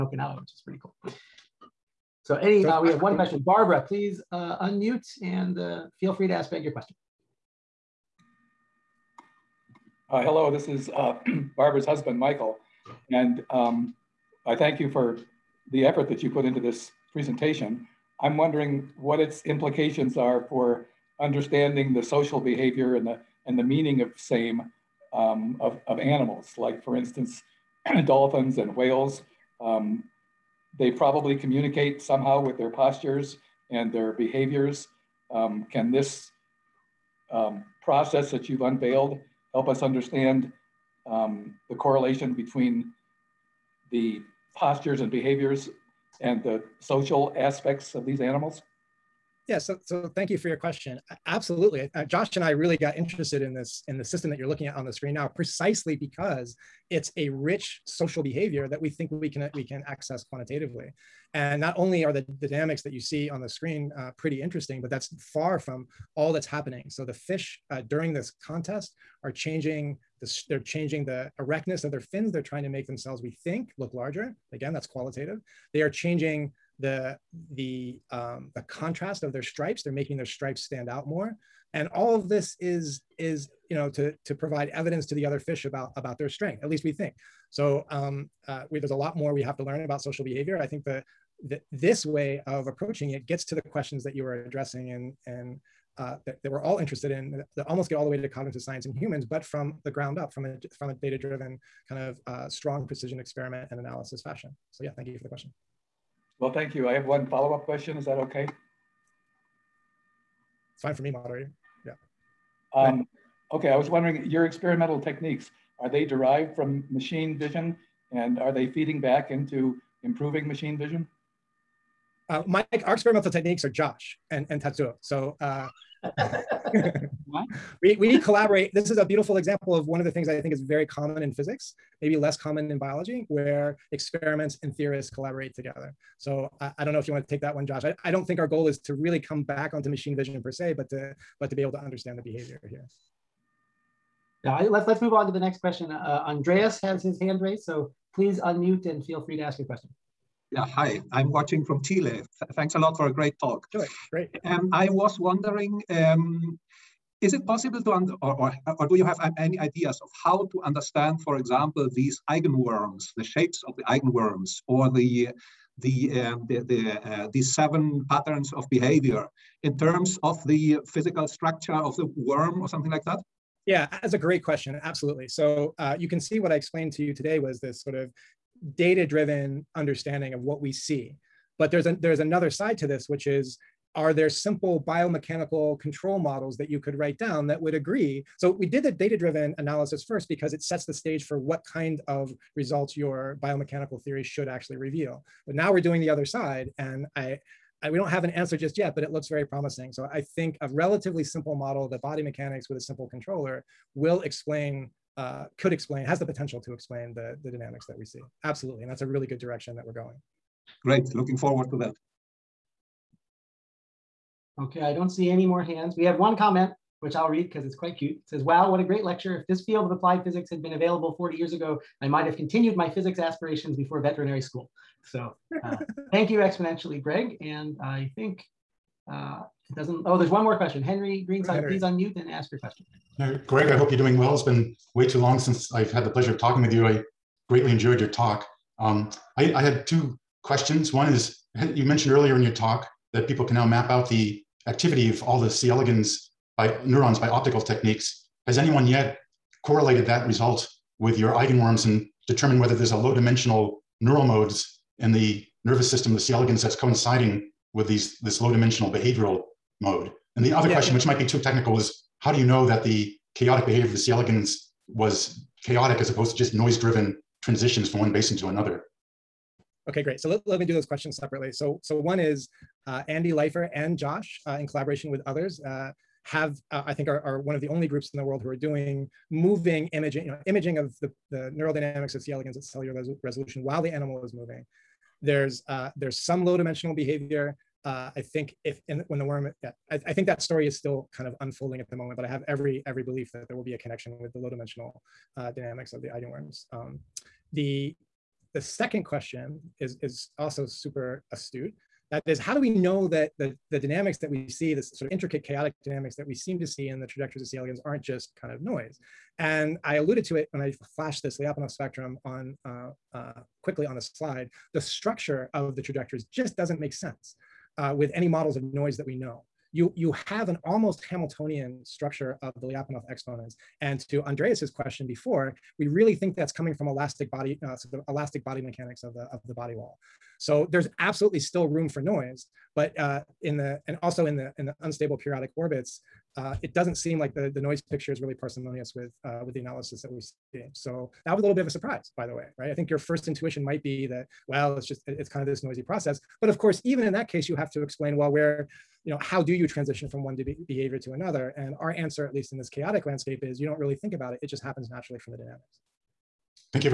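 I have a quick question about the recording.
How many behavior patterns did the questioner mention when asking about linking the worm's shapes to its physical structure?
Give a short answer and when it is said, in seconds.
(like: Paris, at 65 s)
7, at 167 s.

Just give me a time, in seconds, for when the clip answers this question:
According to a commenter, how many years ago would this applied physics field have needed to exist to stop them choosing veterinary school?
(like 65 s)
221 s.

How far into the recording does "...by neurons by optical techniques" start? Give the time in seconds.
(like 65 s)
246 s.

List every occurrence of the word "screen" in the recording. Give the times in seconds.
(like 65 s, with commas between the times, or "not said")
54 s, 63 s.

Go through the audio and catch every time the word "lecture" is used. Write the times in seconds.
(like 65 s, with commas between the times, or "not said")
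219 s.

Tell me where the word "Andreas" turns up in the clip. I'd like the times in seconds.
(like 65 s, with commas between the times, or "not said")
146 s, 324 s.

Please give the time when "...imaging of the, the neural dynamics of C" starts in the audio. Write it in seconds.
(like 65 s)
280 s.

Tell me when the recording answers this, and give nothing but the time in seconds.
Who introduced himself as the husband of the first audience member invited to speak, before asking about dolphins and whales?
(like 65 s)
12 s.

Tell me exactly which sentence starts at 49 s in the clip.
Yeah, so, so thank you for your question.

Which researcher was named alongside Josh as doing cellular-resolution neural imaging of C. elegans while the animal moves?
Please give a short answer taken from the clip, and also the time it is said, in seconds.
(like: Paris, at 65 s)
Andy Leifer, at 273 s.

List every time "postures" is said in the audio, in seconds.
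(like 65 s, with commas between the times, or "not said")
32 s, 44 s.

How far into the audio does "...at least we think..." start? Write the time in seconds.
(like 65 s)
86 s.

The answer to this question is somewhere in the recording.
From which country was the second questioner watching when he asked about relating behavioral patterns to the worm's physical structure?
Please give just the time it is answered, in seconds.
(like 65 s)
151 s.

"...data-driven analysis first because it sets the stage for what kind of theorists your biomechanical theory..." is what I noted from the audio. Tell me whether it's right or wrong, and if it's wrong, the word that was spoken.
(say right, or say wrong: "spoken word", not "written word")
wrong: "results", not "theorists".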